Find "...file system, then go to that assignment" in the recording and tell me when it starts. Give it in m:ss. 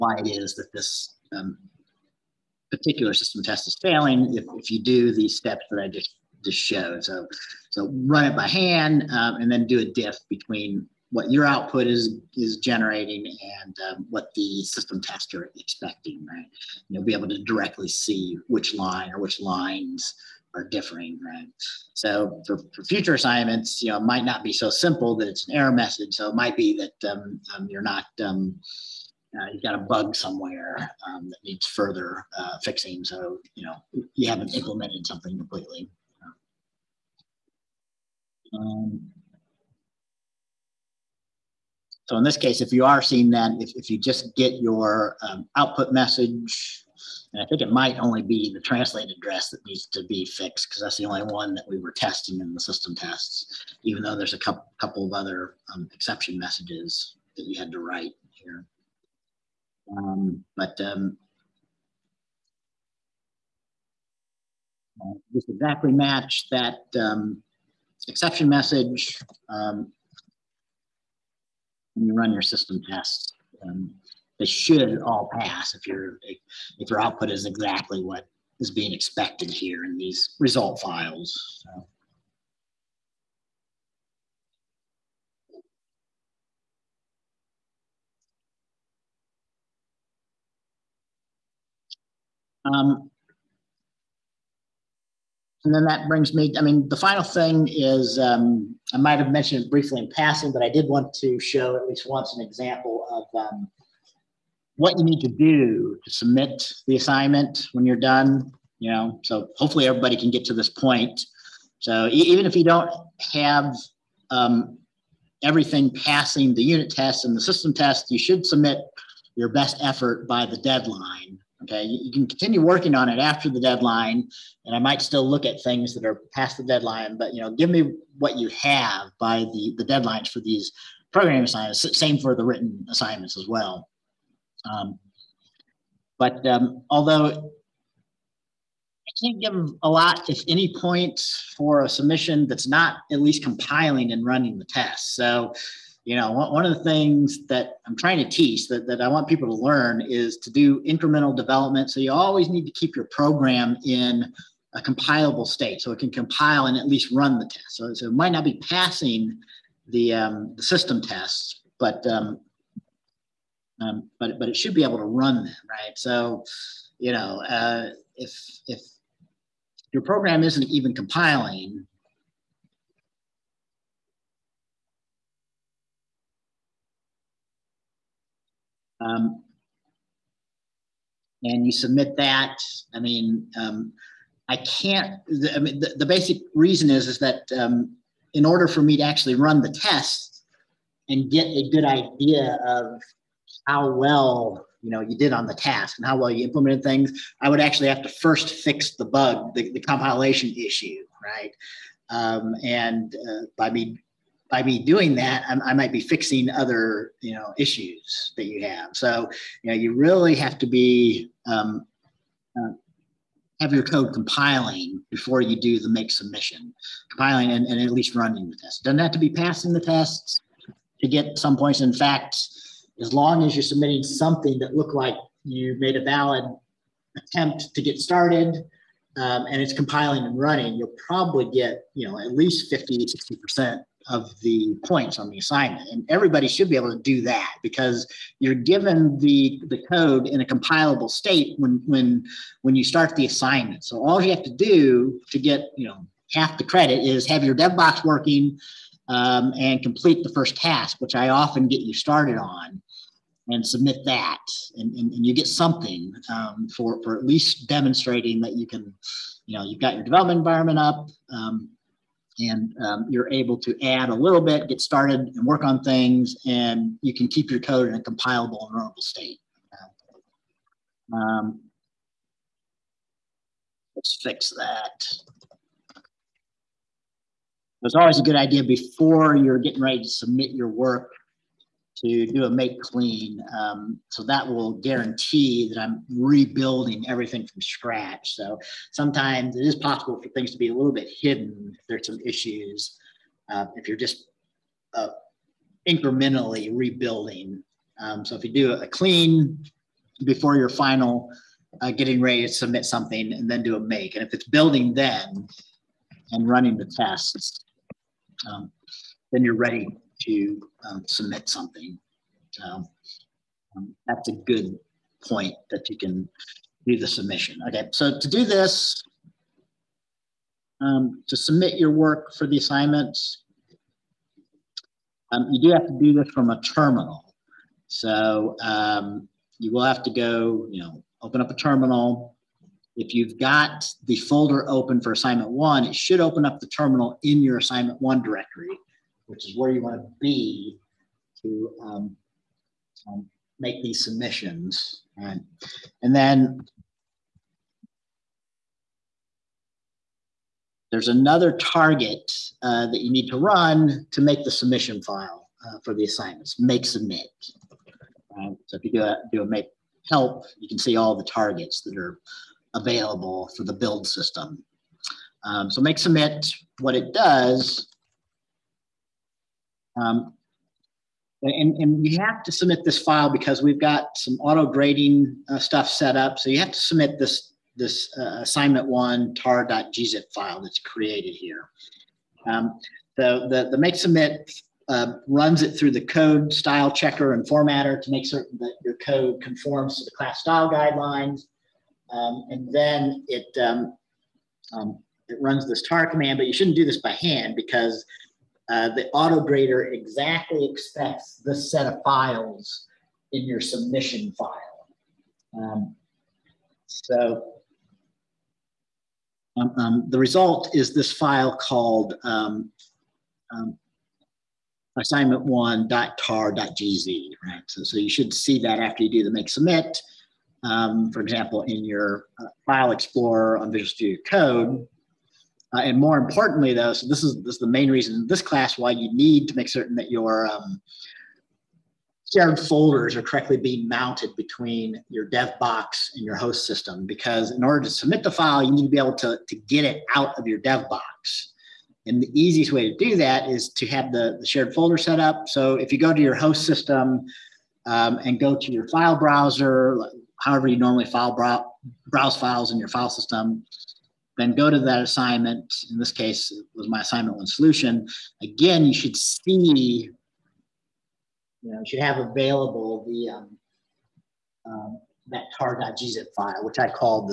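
7:32.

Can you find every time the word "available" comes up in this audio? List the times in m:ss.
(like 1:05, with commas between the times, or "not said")
6:02, 7:42.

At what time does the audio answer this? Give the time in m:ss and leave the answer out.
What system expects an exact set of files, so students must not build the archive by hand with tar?
6:39.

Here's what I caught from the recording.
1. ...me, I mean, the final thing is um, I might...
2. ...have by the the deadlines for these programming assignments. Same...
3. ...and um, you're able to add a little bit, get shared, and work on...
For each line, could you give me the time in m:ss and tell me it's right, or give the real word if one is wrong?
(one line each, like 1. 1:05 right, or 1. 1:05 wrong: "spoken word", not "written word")
1. 1:36 right
2. 2:08 right
3. 4:22 wrong: "started", not "shared".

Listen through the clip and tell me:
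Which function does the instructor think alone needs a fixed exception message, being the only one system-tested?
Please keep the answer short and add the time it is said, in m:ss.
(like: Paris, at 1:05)
translate address, at 0:48.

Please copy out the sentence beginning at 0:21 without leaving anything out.
So for, for future assignments, you know, it might not be so simple that it's an error message.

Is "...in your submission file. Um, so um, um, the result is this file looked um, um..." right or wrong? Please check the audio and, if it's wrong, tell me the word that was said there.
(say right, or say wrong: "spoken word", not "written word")
wrong: "called", not "looked".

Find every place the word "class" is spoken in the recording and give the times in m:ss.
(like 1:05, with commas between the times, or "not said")
6:30, 7:08.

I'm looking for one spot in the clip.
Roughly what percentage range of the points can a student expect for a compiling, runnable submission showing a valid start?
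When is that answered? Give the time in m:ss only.
3:52.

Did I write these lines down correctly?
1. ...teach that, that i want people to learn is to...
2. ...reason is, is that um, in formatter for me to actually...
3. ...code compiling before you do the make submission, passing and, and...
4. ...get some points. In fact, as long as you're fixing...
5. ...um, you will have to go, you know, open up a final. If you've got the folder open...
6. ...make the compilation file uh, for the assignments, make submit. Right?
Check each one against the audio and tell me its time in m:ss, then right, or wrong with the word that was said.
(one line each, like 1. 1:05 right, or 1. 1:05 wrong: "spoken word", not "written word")
1. 2:28 right
2. 3:06 wrong: "order", not "formatter"
3. 3:33 wrong: "compiling", not "passing"
4. 3:41 wrong: "submitting", not "fixing"
5. 5:28 wrong: "terminal", not "final"
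6. 5:54 wrong: "submission", not "compilation".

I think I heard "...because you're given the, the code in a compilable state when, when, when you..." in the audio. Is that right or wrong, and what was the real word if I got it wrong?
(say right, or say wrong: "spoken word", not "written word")
right.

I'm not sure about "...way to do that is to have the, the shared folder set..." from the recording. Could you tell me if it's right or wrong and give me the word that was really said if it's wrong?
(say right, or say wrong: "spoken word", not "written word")
right.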